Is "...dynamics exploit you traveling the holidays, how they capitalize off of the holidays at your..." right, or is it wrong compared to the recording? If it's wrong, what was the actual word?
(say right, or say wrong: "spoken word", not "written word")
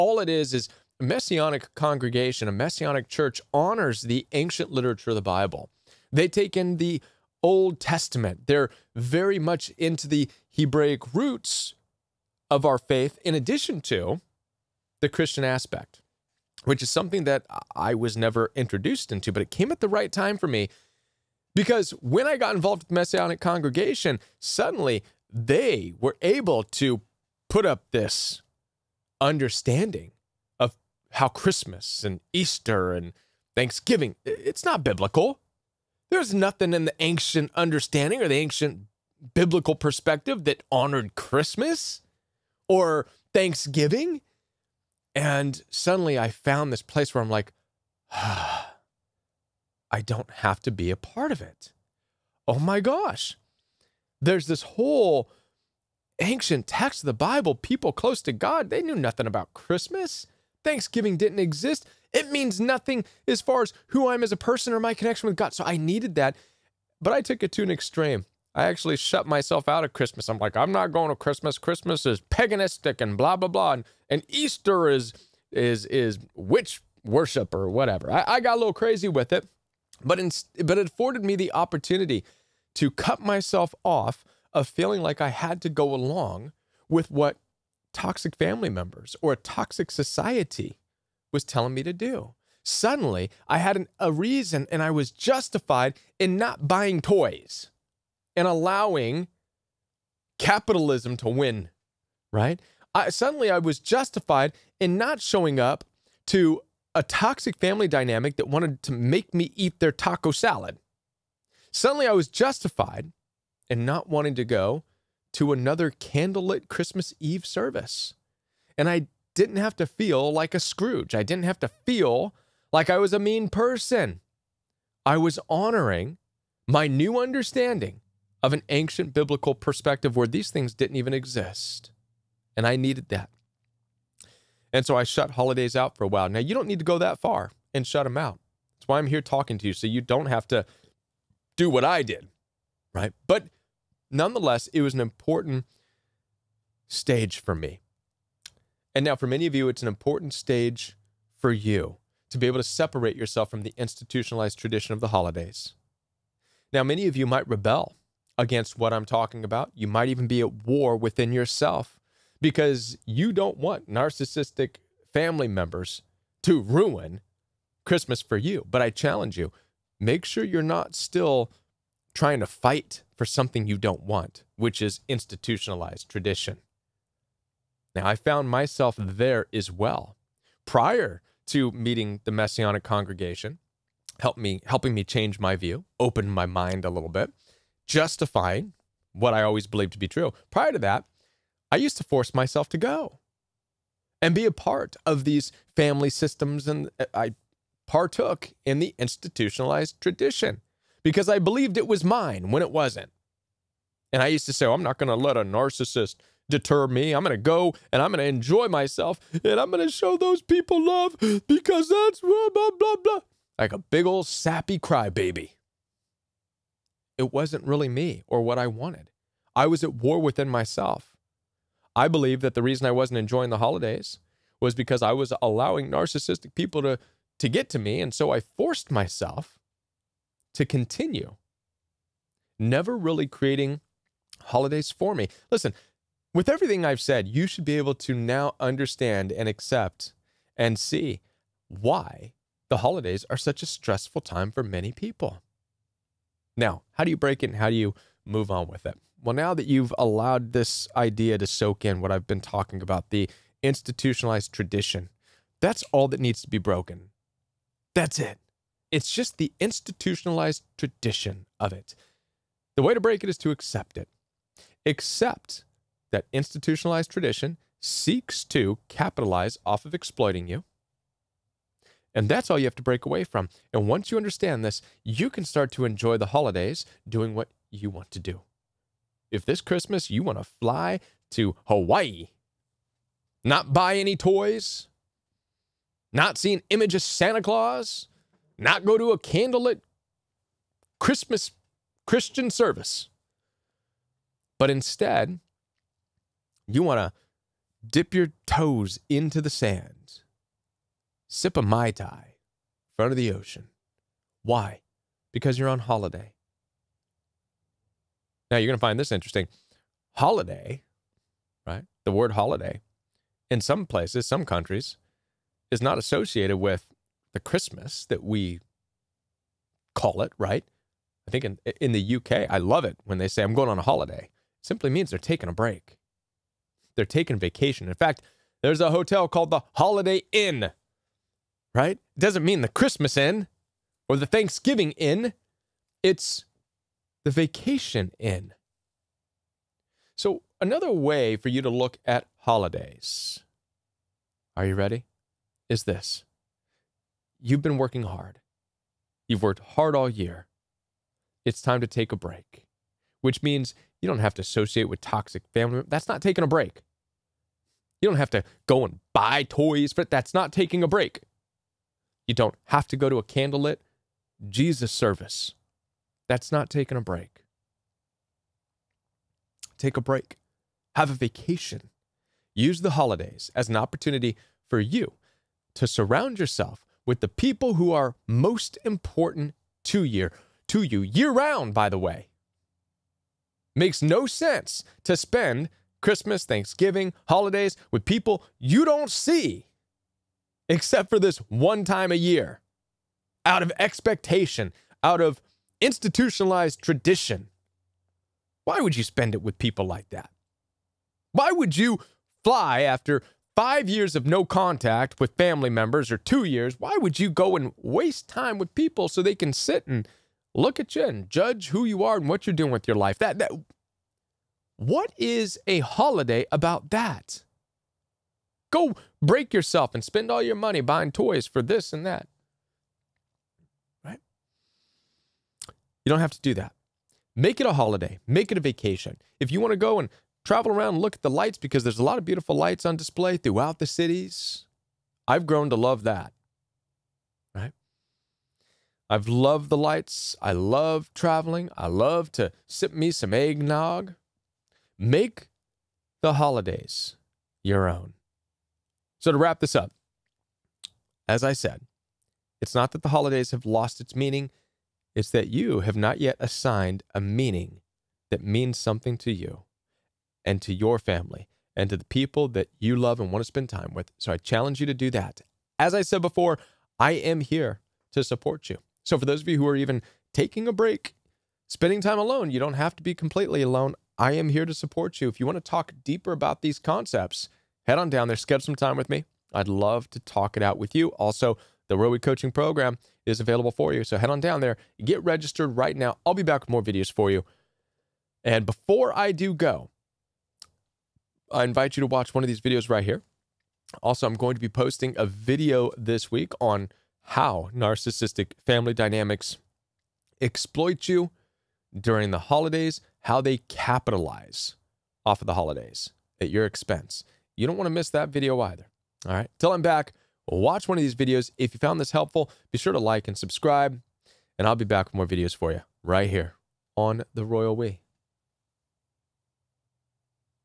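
wrong: "during", not "traveling".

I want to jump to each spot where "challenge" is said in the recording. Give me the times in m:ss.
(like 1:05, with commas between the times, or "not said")
2:48, 7:44.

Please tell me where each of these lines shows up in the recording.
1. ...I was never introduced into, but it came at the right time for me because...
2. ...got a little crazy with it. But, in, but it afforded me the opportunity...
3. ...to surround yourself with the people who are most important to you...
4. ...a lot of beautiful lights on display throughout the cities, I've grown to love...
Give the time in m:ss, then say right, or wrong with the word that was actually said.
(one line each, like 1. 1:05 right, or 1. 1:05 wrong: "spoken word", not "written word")
1. 0:17 right
2. 1:18 right
3. 6:15 right
4. 7:11 right.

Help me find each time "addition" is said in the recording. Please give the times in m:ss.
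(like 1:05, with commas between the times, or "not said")
0:13.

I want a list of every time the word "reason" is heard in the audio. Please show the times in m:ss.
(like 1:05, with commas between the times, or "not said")
1:34, 3:42.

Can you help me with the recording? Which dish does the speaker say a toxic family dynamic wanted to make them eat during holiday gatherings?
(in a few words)
taco salad.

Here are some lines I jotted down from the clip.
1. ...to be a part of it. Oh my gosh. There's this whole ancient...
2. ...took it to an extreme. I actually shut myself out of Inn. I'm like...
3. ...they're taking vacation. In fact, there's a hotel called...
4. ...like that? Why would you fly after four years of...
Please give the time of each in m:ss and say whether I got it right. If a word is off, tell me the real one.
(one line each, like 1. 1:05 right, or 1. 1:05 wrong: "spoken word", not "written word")
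1. 0:50 right
2. 1:07 wrong: "Christmas", not "Inn"
3. 5:26 right
4. 6:39 wrong: "five", not "four".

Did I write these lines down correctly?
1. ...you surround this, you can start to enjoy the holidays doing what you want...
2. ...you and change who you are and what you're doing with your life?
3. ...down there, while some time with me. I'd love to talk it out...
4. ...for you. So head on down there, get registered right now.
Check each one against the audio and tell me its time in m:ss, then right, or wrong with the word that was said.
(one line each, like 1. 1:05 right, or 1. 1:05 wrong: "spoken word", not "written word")
1. 4:34 wrong: "understand", not "surround"
2. 6:50 wrong: "judge", not "change"
3. 7:58 wrong: "schedule", not "while"
4. 8:03 right.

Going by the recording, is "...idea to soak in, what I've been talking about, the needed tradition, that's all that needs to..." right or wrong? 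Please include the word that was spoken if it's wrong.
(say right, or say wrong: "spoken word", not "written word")
wrong: "institutionalized", not "needed".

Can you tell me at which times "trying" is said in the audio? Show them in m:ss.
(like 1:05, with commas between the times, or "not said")
2:52.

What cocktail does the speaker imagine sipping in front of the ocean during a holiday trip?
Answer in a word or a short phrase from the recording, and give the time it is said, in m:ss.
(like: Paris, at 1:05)
Mai Tai, at 5:01.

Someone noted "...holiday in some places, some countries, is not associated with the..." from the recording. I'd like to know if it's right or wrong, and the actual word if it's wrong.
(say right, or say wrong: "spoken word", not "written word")
right.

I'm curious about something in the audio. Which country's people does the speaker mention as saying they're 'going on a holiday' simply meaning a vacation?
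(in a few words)
UK.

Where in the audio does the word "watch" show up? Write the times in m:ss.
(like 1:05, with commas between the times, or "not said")
8:12, 8:30.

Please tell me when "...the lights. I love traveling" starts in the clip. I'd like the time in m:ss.
7:19.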